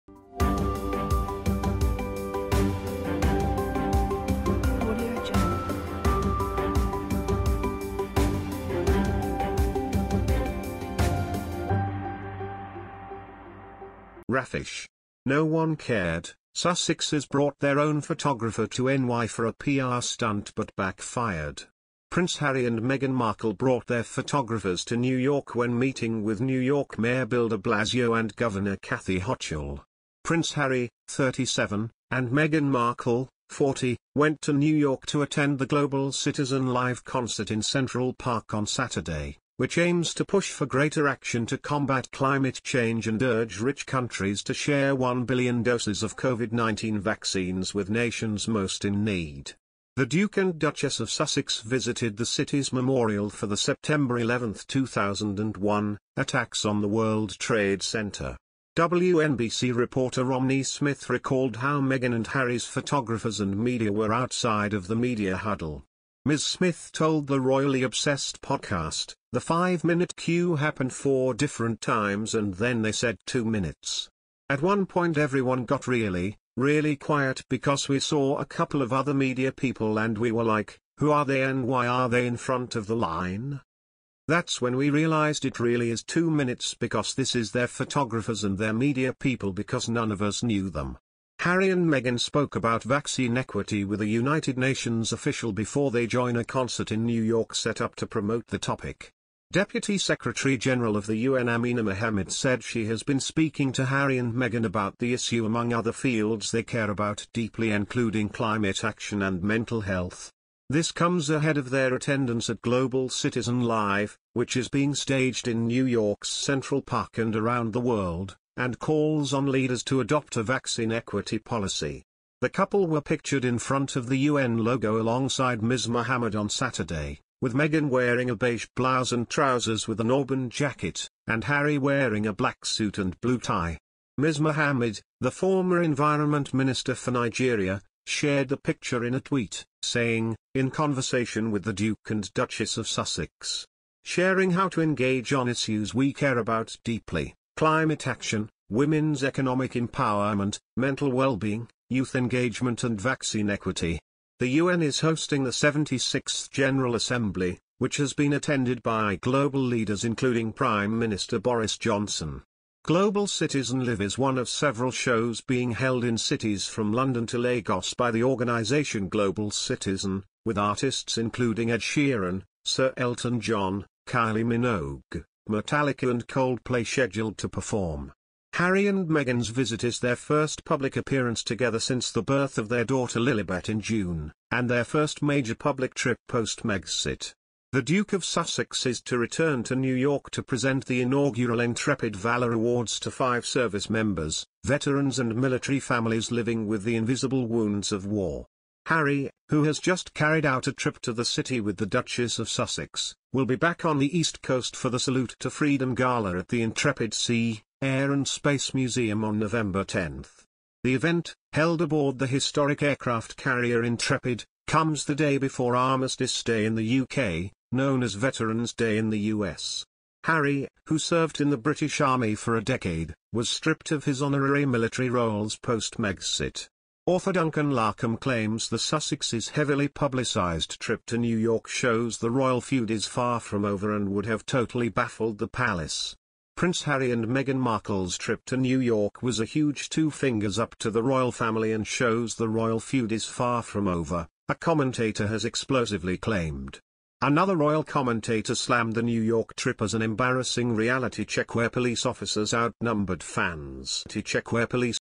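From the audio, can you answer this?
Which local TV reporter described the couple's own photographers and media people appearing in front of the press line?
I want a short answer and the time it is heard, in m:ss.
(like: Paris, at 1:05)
Romney Smith, at 1:00.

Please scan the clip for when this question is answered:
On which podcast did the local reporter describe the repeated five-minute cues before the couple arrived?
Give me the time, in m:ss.
1:07.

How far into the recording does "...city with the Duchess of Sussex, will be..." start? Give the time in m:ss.
3:21.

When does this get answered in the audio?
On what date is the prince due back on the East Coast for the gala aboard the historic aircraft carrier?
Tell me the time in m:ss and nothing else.
3:29.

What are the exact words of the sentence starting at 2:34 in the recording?
The UN is hosting the 76th General Assembly, which has been attended by global leaders including Prime Minister Boris Johnson.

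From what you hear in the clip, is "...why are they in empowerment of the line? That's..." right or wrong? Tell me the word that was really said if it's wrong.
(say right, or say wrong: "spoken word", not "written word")
wrong: "front", not "empowerment".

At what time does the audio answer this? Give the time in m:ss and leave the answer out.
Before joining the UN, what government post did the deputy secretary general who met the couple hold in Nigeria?
2:15.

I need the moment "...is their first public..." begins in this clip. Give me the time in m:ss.
2:59.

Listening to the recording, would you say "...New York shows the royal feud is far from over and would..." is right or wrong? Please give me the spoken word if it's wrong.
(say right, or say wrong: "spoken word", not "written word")
right.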